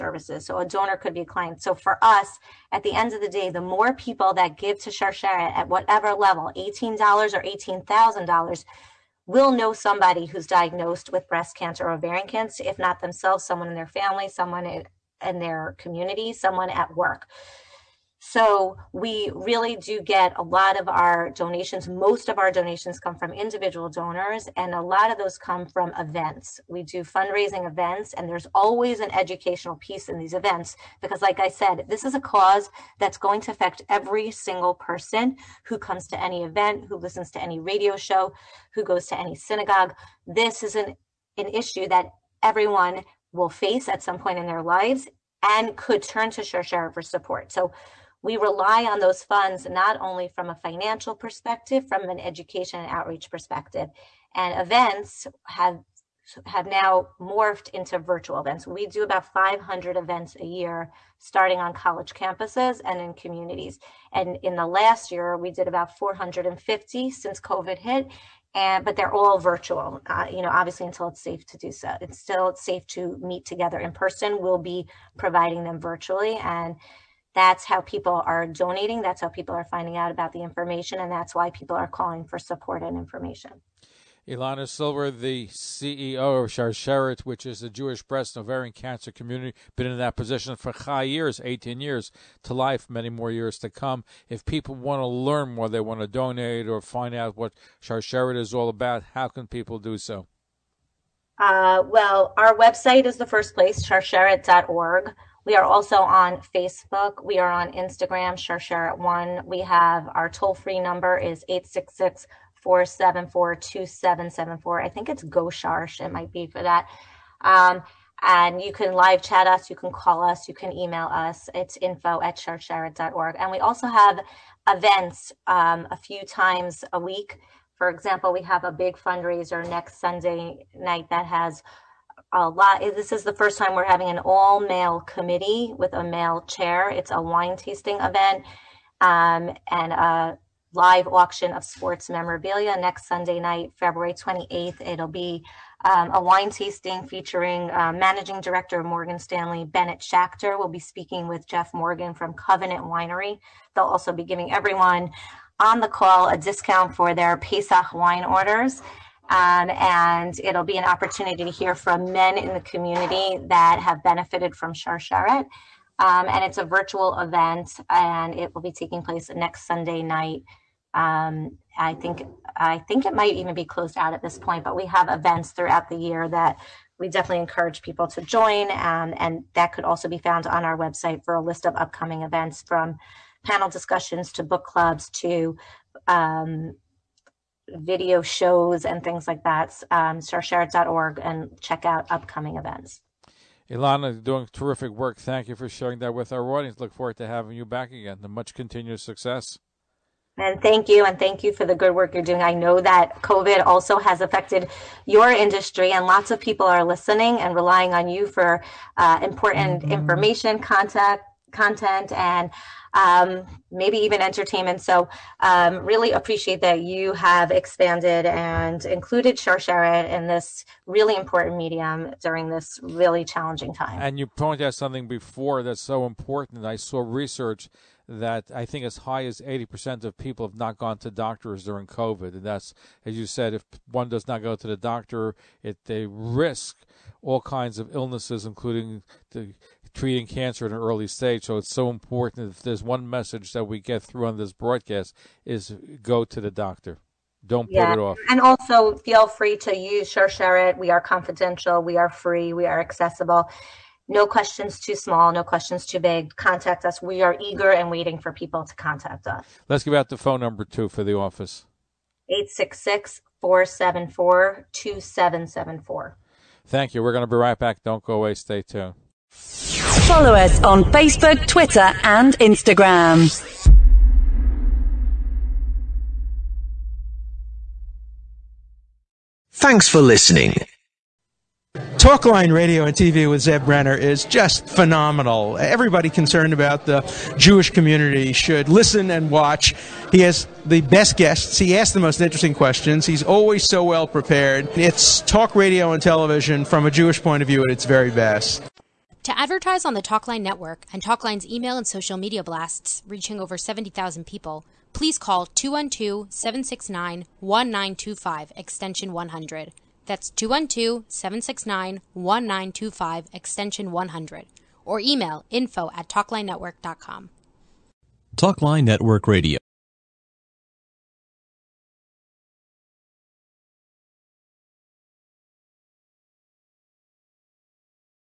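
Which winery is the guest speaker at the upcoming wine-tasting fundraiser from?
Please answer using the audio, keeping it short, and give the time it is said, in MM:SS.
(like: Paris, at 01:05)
Covenant Winery, at 02:32.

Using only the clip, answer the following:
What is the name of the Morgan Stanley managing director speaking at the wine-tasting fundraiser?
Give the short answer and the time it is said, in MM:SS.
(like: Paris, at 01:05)
Bennett Schachter, at 02:29.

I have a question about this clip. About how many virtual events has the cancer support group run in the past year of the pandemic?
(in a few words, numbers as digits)
450.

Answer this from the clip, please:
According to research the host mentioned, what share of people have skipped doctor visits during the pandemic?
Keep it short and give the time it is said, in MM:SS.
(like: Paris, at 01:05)
80%, at 03:49.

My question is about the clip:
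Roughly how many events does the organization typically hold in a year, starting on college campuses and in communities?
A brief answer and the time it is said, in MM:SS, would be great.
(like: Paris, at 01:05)
500, at 00:59.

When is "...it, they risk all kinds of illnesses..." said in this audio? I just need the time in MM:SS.
03:55.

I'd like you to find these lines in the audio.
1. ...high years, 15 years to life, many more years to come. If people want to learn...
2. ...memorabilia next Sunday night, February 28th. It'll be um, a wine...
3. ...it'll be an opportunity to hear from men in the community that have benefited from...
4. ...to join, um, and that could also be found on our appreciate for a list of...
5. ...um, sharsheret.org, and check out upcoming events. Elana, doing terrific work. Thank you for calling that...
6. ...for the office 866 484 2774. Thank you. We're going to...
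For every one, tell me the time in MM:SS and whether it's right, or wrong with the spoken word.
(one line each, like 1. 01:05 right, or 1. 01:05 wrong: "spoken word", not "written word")
1. 01:30 wrong: "18", not "15"
2. 02:22 right
3. 02:40 right
4. 02:58 wrong: "website", not "appreciate"
5. 03:09 wrong: "sharing", not "calling"
6. 04:20 wrong: "474", not "484".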